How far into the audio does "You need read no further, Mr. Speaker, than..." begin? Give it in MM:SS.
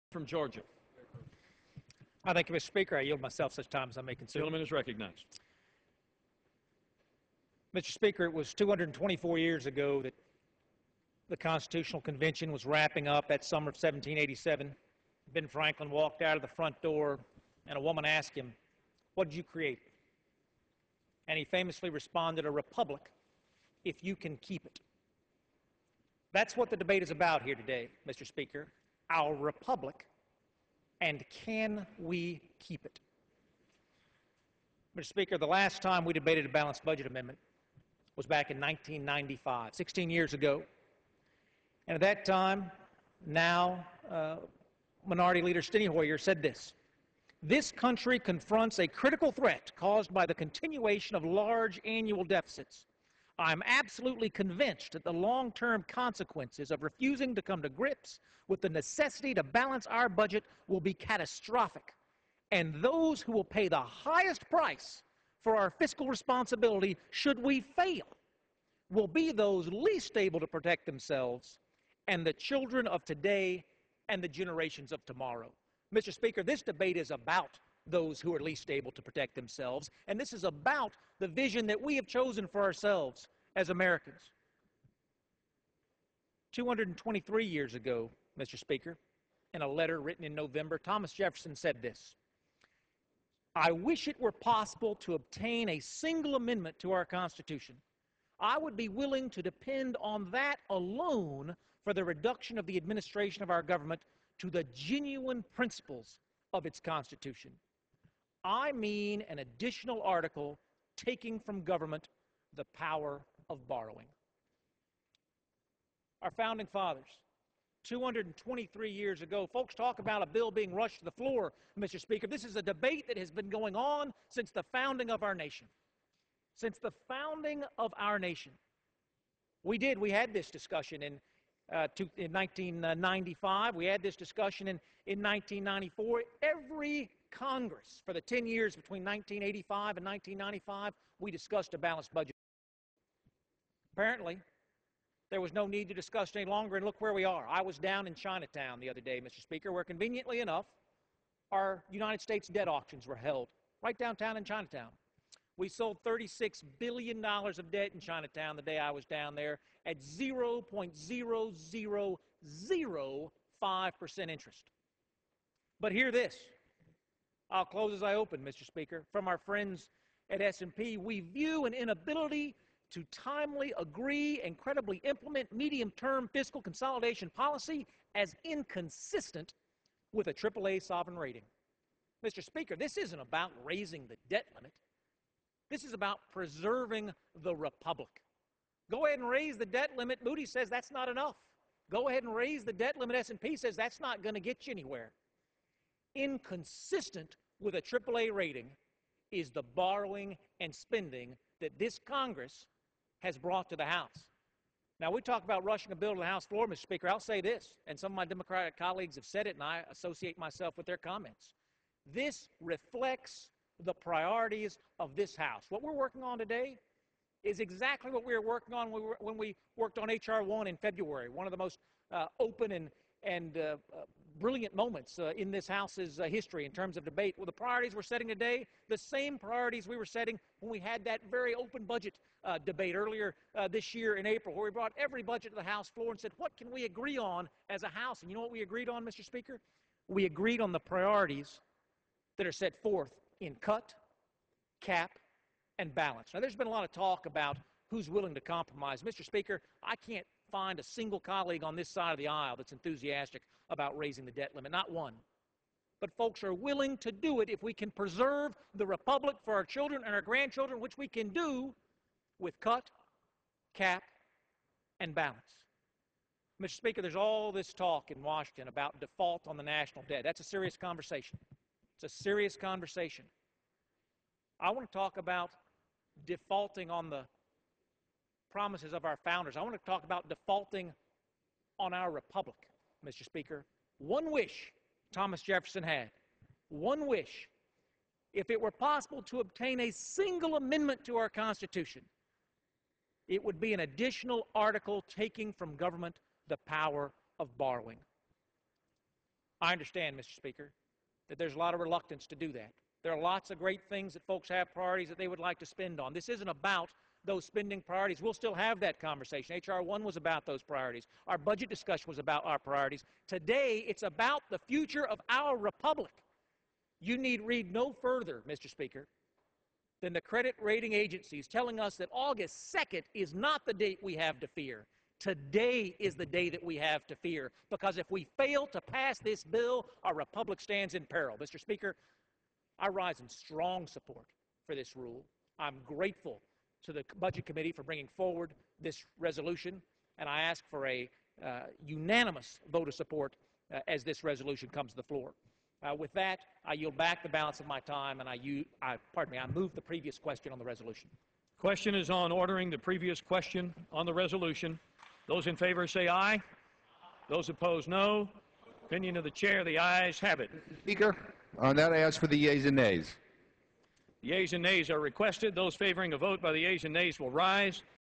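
05:16.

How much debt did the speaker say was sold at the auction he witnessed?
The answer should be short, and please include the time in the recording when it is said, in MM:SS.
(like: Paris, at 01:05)
$36 billion, at 02:36.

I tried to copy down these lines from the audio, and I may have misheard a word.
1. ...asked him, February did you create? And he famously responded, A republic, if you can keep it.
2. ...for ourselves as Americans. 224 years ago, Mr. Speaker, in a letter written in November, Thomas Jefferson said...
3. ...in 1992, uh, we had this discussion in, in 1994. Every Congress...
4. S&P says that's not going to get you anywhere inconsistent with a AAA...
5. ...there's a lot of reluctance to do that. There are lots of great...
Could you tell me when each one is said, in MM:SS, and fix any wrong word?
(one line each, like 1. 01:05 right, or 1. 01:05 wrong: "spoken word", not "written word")
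1. 00:18 wrong: "What", not "February"
2. 01:22 wrong: "223", not "224"
3. 02:12 wrong: "1995", not "1992"
4. 03:13 right
5. 05:01 right.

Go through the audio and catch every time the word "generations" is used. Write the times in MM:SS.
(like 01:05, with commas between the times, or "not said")
01:14.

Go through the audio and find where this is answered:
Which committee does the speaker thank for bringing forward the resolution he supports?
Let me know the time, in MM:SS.
05:37.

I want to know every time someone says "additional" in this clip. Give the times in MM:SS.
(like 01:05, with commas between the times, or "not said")
01:49, 04:53.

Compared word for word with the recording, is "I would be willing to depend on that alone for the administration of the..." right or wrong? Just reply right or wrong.
wrong.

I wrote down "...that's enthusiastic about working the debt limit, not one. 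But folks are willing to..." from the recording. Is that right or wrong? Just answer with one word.
wrong.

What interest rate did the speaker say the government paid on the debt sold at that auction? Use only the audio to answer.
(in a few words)
0.0005%.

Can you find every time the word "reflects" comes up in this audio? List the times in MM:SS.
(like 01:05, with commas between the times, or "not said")
03:32.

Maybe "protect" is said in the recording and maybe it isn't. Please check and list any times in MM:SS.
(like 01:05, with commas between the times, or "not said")
01:10, 01:19.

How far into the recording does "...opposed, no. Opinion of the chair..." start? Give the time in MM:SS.
05:57.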